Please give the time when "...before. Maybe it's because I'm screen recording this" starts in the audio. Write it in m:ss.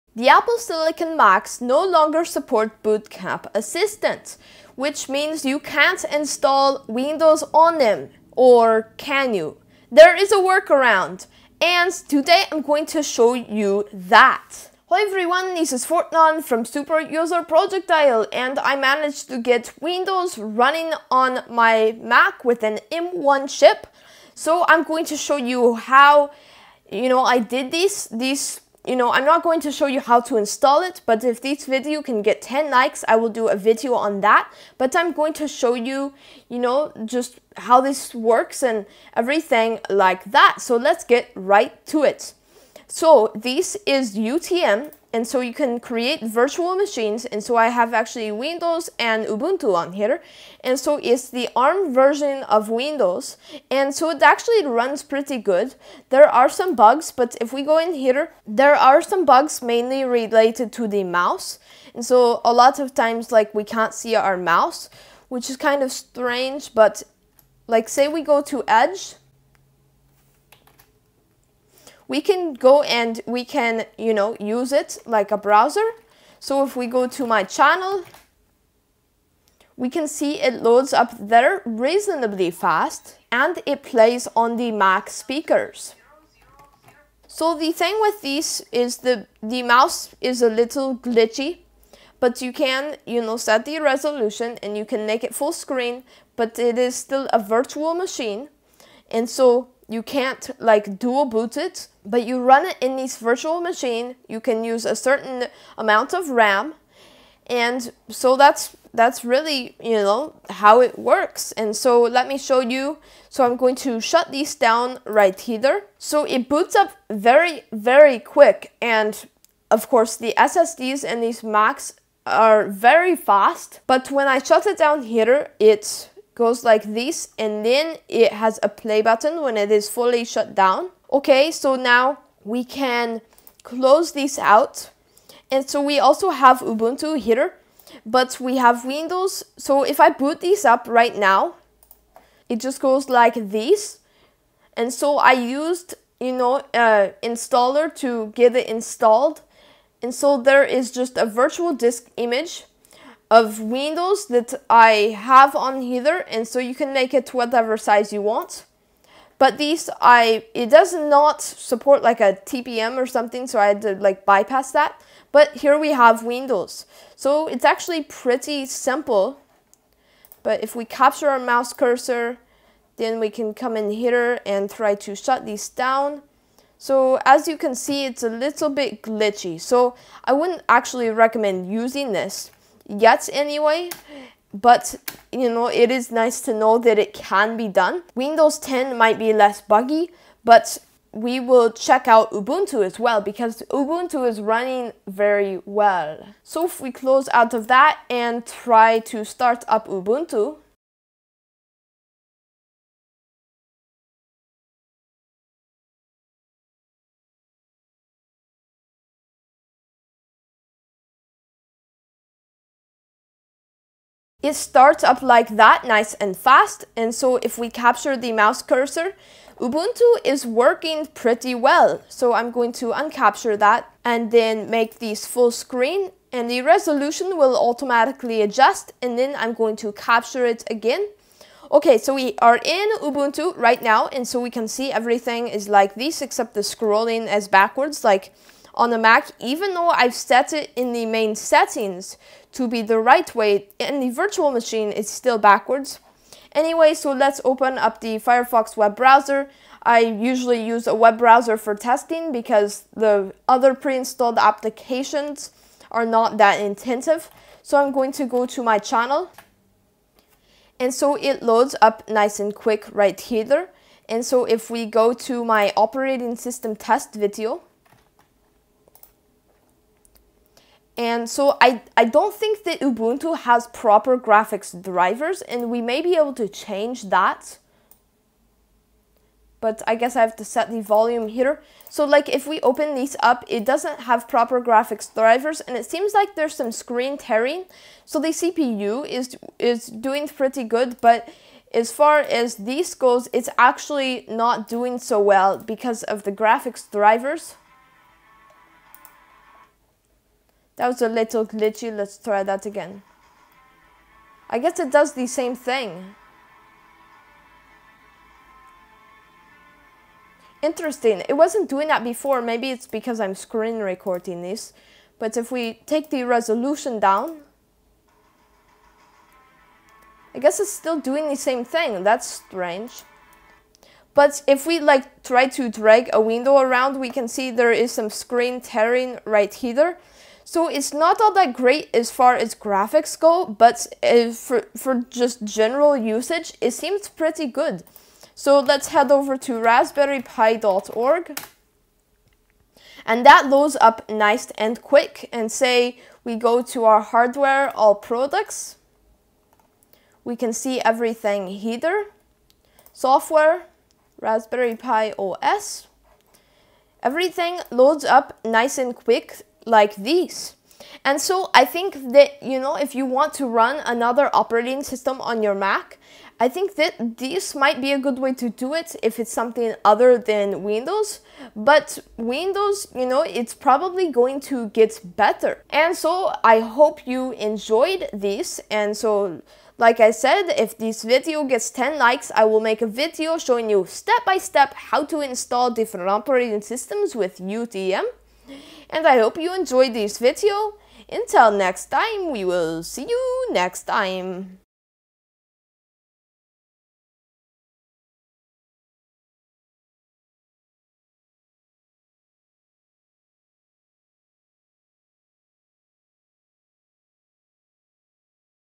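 5:12.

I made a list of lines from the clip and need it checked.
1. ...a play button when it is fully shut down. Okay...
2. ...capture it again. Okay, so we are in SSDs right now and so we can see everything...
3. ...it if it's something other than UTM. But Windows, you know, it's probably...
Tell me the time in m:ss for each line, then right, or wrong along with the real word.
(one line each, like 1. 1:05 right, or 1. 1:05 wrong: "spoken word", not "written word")
1. 2:08 right
2. 3:49 wrong: "Ubuntu", not "SSDs"
3. 6:08 wrong: "Windows", not "UTM".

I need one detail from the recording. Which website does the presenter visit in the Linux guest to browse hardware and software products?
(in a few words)
raspberrypi.org.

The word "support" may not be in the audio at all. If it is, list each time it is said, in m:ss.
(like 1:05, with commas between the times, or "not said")
0:02, 2:41.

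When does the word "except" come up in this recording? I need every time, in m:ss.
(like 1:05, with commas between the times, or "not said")
3:56.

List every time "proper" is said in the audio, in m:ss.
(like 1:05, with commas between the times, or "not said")
4:33, 4:44.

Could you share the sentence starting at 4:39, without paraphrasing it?
But I guess I have to set the volume here.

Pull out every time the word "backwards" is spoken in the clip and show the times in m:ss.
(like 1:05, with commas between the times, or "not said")
3:57, 4:05.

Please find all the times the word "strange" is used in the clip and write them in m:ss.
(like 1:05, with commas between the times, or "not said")
1:05, 5:22.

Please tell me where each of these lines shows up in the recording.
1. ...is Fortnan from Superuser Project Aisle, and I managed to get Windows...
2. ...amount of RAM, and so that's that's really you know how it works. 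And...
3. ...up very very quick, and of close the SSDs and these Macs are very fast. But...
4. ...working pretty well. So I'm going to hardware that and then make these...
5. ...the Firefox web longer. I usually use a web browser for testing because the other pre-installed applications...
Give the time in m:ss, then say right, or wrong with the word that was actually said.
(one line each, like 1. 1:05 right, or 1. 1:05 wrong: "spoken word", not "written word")
1. 0:15 right
2. 1:45 right
3. 1:56 wrong: "course", not "close"
4. 3:40 wrong: "uncapture", not "hardware"
5. 4:08 wrong: "browser", not "longer".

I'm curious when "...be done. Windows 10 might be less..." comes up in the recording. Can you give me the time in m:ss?
3:07.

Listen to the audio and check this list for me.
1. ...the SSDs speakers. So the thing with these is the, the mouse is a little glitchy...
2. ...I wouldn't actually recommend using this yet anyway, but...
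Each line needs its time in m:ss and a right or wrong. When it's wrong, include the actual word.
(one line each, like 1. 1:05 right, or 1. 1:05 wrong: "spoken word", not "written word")
1. 1:24 wrong: "Mac", not "SSDs"
2. 3:00 right.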